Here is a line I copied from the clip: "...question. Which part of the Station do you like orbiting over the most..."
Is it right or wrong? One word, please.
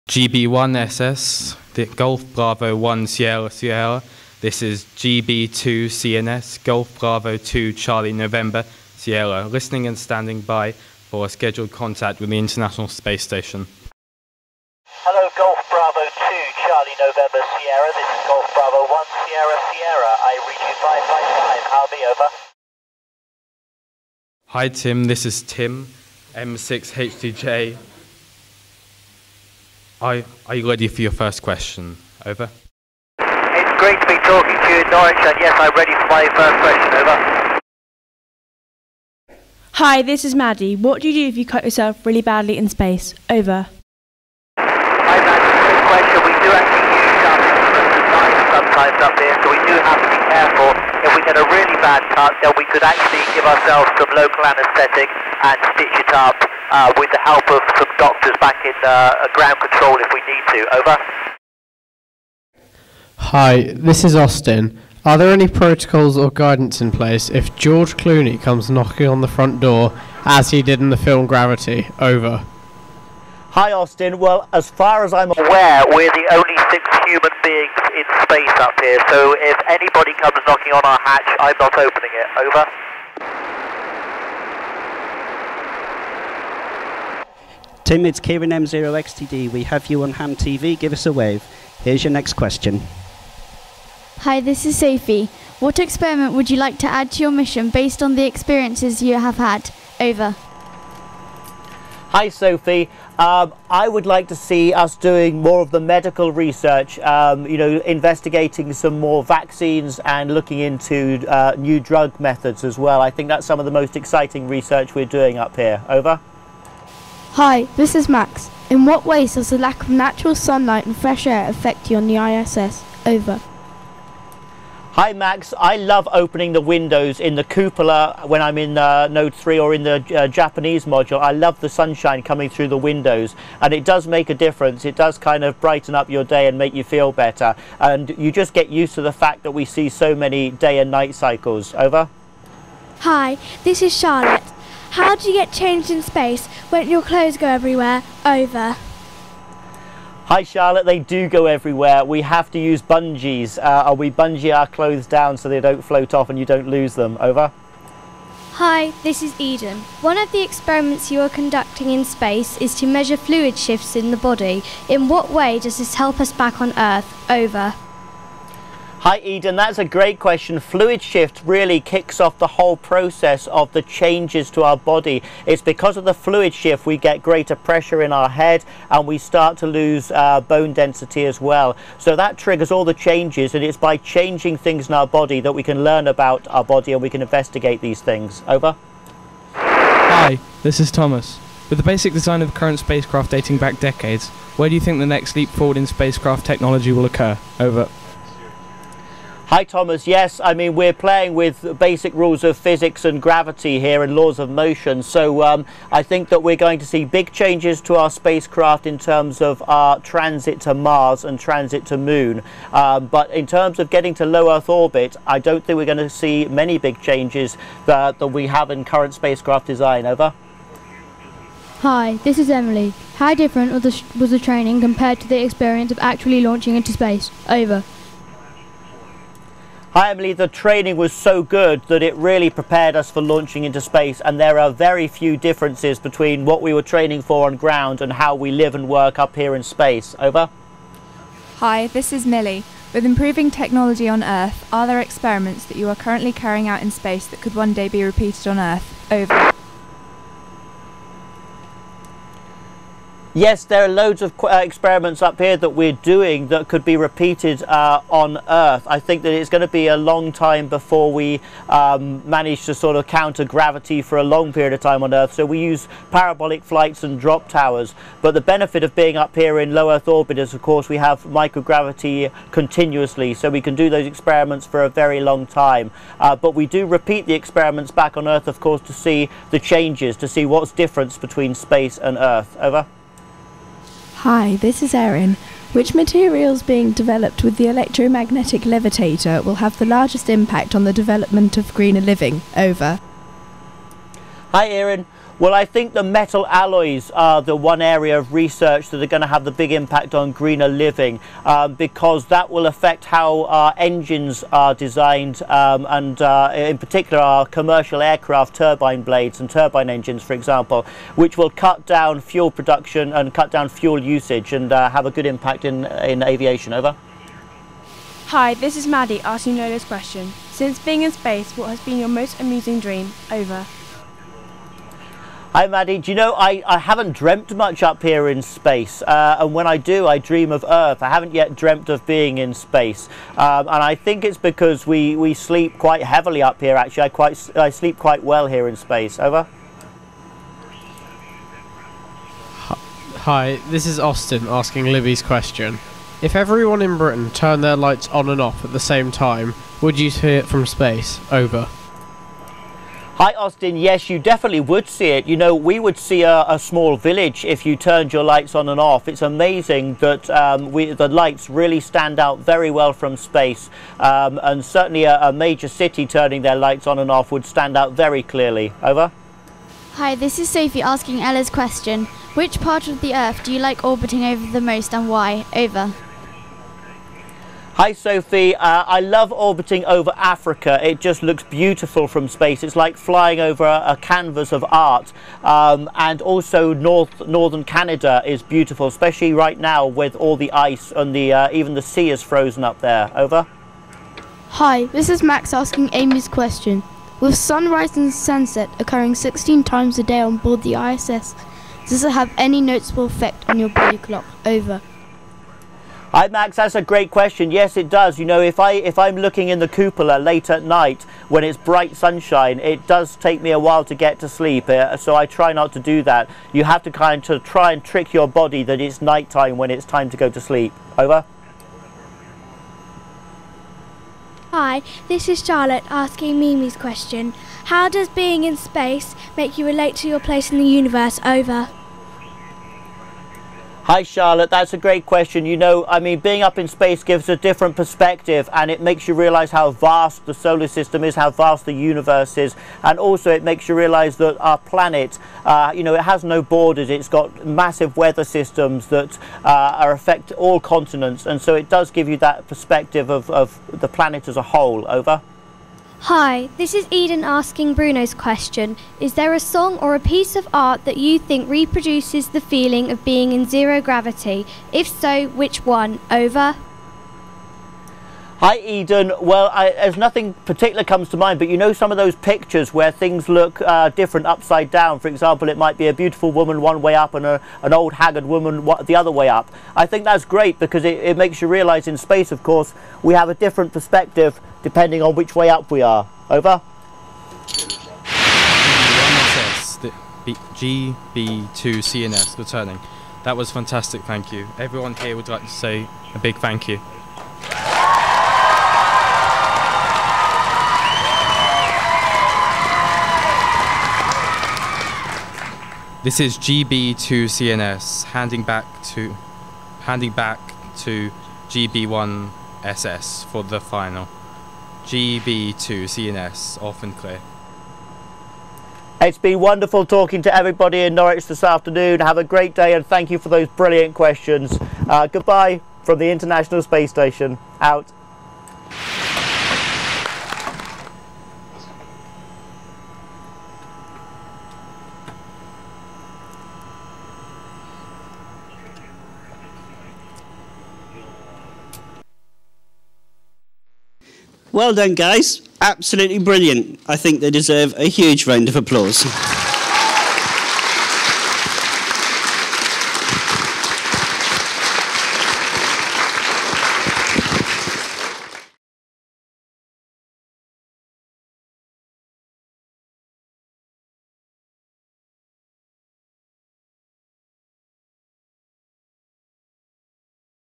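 wrong.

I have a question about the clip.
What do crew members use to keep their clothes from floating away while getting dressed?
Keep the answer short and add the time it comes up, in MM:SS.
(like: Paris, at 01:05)
Bungees, at 02:32.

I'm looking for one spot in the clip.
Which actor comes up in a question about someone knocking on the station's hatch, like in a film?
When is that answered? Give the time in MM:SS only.
01:07.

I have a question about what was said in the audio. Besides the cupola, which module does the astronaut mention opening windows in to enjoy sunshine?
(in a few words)
Japanese module.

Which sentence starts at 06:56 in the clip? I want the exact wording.
You have to kind of try and trick your body that it's nighttime when it's time to go to sleep.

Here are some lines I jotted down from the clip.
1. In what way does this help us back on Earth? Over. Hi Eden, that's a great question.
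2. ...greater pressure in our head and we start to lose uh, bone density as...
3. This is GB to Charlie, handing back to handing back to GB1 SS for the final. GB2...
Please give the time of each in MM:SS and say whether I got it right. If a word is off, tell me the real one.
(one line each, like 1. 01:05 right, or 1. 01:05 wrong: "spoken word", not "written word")
1. 02:44 right
2. 02:57 right
3. 08:26 wrong: "CNS", not "Charlie".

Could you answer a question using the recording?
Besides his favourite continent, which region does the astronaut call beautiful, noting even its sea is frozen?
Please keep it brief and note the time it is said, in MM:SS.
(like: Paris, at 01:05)
Northern Canada, at 06:27.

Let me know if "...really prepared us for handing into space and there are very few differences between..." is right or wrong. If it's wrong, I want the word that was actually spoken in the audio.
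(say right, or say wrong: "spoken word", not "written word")
wrong: "launching", not "handing".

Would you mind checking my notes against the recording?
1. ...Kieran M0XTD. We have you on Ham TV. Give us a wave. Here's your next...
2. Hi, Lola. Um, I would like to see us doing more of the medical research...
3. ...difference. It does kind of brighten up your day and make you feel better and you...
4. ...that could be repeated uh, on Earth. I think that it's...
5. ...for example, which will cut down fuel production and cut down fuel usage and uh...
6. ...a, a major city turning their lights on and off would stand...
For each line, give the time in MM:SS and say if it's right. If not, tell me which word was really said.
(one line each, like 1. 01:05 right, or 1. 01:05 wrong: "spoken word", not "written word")
1. 01:28 right
2. 01:42 wrong: "Sophie", not "Lola"
3. 02:14 right
4. 04:16 right
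5. 05:10 right
6. 06:05 right.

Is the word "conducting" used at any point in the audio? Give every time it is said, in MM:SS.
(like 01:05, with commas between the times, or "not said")
02:41.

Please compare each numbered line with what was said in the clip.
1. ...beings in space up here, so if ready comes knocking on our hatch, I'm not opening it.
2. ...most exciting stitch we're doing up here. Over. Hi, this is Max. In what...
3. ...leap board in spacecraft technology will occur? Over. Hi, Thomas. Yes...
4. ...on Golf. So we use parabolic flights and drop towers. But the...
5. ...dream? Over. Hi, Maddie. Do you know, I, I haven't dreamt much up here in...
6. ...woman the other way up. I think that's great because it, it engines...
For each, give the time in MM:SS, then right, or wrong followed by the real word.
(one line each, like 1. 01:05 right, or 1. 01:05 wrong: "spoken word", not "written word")
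1. 01:17 wrong: "anybody", not "ready"
2. 01:53 wrong: "research", not "stitch"
3. 03:15 wrong: "forward", not "board"
4. 04:25 wrong: "Earth", not "Golf"
5. 05:22 right
6. 07:58 wrong: "makes", not "engines".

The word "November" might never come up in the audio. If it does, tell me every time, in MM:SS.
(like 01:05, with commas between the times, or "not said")
00:08, 00:16.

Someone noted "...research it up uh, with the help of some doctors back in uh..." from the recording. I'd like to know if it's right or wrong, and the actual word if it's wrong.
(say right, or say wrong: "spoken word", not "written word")
wrong: "stitch", not "research".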